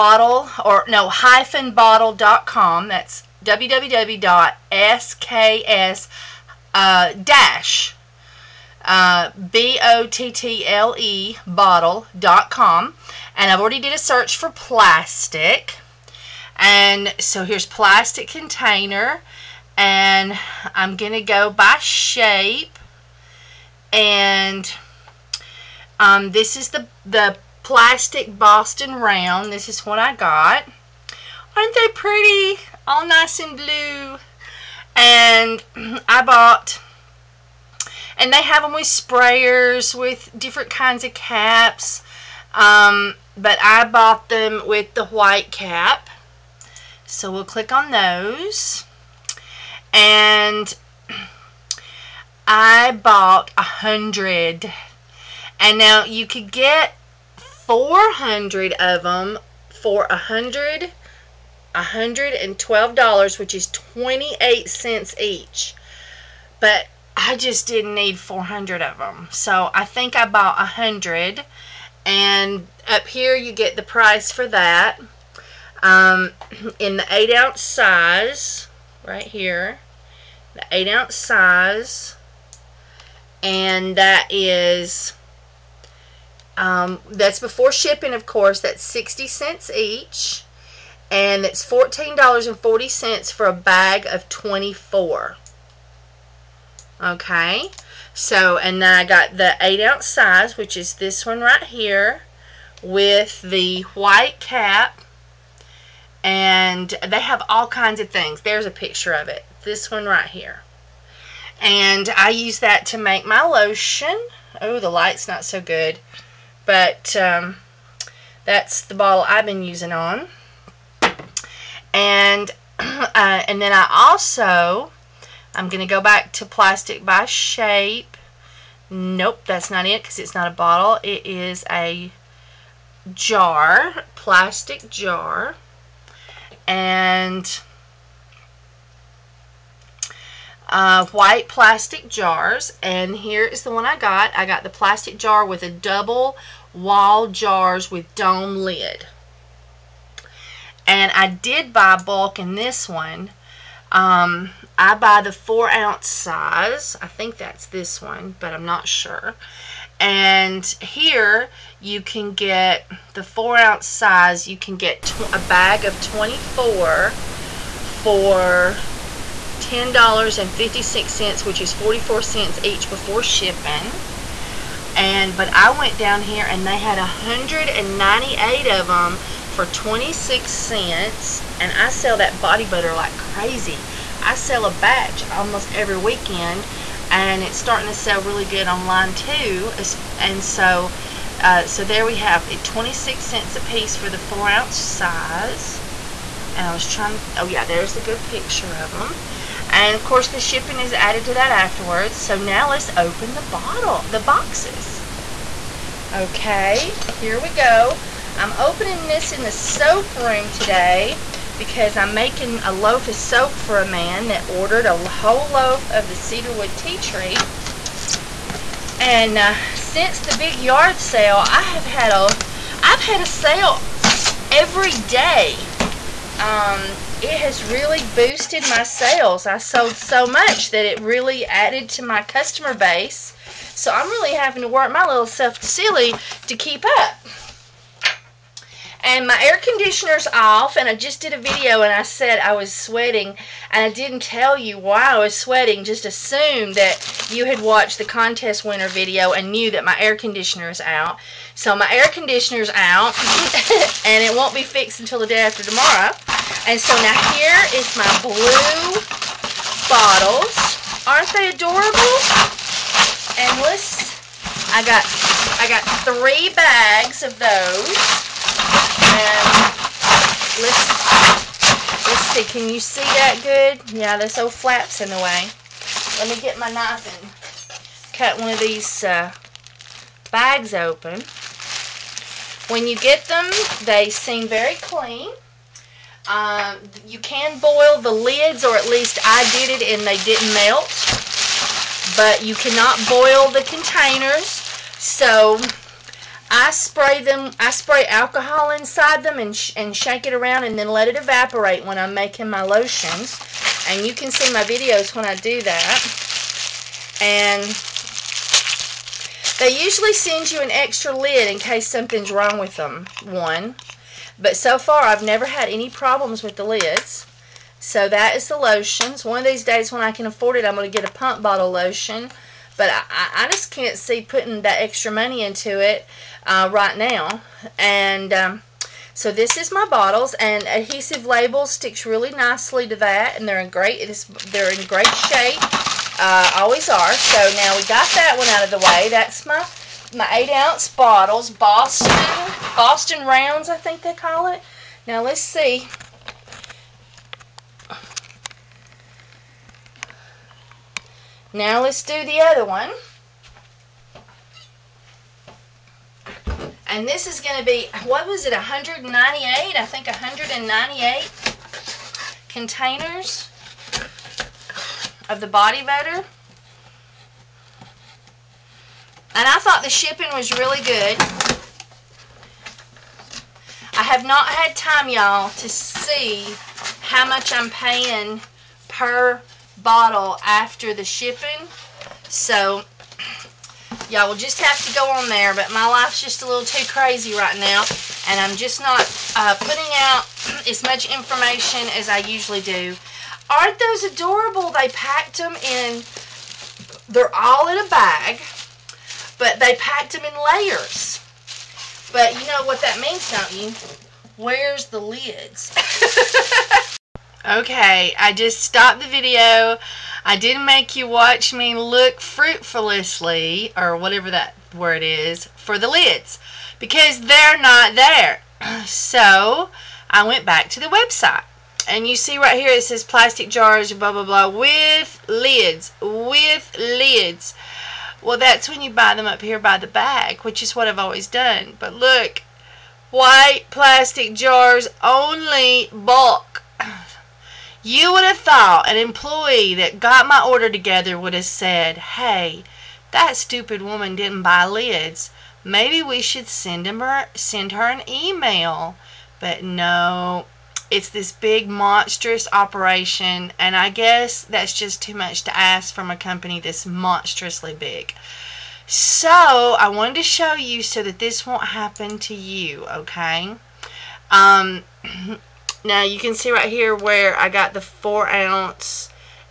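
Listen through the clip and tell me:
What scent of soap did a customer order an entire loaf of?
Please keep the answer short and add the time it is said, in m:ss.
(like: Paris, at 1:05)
cedarwood tea tree, at 3:36.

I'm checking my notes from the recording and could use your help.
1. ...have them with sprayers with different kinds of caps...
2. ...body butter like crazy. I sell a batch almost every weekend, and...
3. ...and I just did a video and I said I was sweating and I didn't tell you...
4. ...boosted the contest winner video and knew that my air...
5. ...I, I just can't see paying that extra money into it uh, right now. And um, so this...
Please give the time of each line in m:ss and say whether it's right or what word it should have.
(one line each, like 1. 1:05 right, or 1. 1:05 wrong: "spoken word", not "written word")
1. 0:38 right
2. 3:02 right
3. 4:00 right
4. 4:07 wrong: "watched", not "boosted"
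5. 5:22 wrong: "putting", not "paying".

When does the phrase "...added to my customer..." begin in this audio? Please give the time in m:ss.
3:51.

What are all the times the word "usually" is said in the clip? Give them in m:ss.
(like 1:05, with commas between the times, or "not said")
5:09, 6:32.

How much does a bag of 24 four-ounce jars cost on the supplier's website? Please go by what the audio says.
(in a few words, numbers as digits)
$10.56.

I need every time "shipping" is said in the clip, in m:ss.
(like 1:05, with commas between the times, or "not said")
1:27, 2:53, 3:20, 6:09, 6:21.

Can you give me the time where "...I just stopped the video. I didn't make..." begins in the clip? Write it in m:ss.
6:48.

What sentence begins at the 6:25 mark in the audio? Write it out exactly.
But my life's just a little too crazy right now.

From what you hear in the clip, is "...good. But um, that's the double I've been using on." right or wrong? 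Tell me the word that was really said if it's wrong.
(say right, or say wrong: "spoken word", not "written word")
wrong: "bottle", not "double".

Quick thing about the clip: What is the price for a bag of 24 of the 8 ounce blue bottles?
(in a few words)
$14.40.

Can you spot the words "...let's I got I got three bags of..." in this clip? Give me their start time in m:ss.
4:23.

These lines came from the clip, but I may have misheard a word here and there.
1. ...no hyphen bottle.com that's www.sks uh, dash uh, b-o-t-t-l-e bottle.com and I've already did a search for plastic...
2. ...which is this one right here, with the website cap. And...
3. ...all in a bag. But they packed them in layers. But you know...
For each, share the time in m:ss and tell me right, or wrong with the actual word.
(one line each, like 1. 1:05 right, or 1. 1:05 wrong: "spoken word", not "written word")
1. 0:00 right
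2. 1:40 wrong: "white", not "website"
3. 6:37 right.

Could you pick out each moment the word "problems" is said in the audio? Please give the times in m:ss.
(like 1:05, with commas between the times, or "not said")
5:15.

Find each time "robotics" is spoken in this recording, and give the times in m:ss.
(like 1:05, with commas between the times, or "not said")
not said.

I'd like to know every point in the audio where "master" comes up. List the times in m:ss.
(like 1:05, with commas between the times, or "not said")
not said.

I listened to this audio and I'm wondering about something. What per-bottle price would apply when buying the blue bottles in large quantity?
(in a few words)
28 cents.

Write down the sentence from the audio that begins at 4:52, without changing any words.
But you cannot boil the containers.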